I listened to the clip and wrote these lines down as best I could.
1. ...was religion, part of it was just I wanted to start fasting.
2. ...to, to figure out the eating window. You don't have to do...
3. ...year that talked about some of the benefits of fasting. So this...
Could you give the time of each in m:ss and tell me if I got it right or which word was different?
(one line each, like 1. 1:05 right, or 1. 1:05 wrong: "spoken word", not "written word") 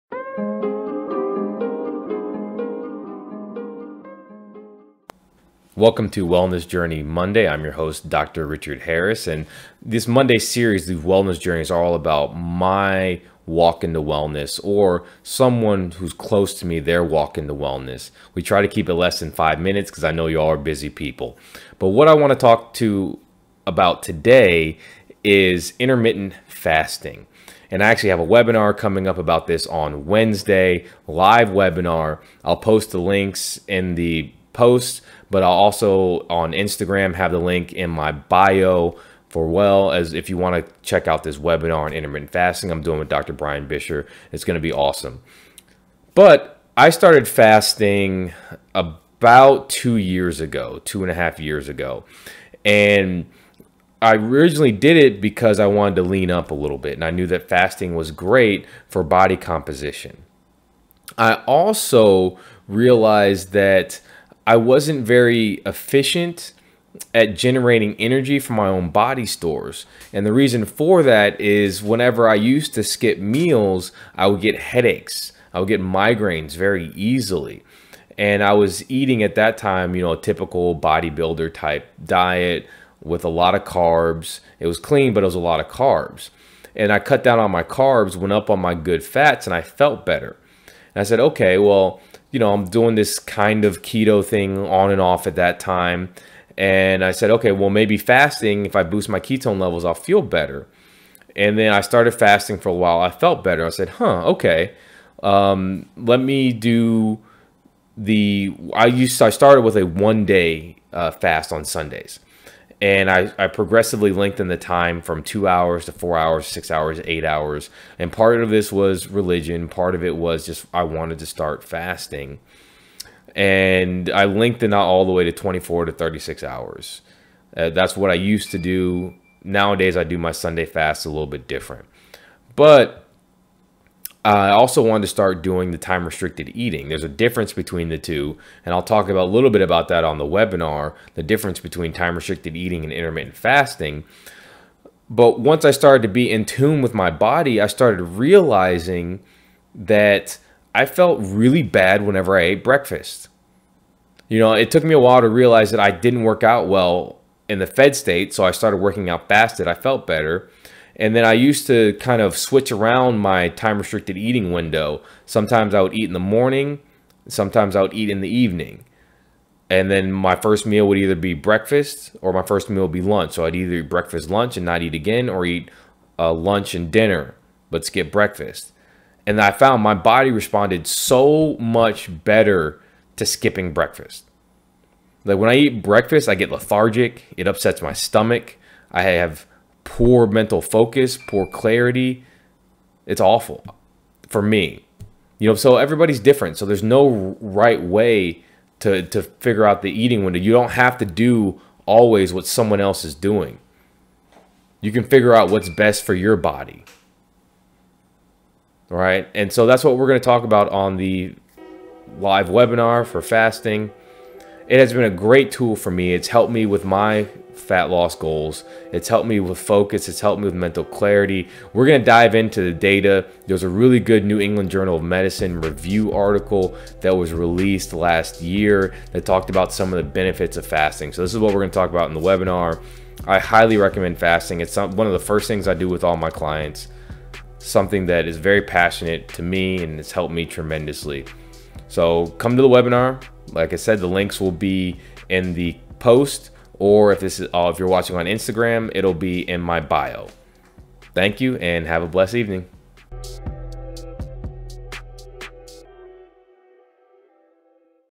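1. 1:58 right
2. 3:18 right
3. 3:48 right.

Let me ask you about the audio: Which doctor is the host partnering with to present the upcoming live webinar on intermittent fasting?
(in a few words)
Dr. Brian Bisher.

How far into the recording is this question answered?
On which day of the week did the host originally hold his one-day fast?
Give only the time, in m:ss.
1:51.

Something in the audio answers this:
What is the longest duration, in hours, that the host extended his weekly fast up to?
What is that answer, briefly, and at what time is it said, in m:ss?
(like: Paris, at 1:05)
36 hours, at 2:05.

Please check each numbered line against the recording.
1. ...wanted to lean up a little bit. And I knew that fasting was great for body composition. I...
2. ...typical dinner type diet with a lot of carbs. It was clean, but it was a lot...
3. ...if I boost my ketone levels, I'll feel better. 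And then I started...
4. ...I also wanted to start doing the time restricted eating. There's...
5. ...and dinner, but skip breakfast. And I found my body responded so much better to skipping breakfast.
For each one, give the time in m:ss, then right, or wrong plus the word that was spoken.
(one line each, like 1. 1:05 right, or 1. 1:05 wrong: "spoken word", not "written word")
1. 0:55 right
2. 1:20 wrong: "bodybuilder", not "dinner"
3. 1:38 right
4. 2:14 right
5. 2:56 right.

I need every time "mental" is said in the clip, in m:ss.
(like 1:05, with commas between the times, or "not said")
3:10, 3:40.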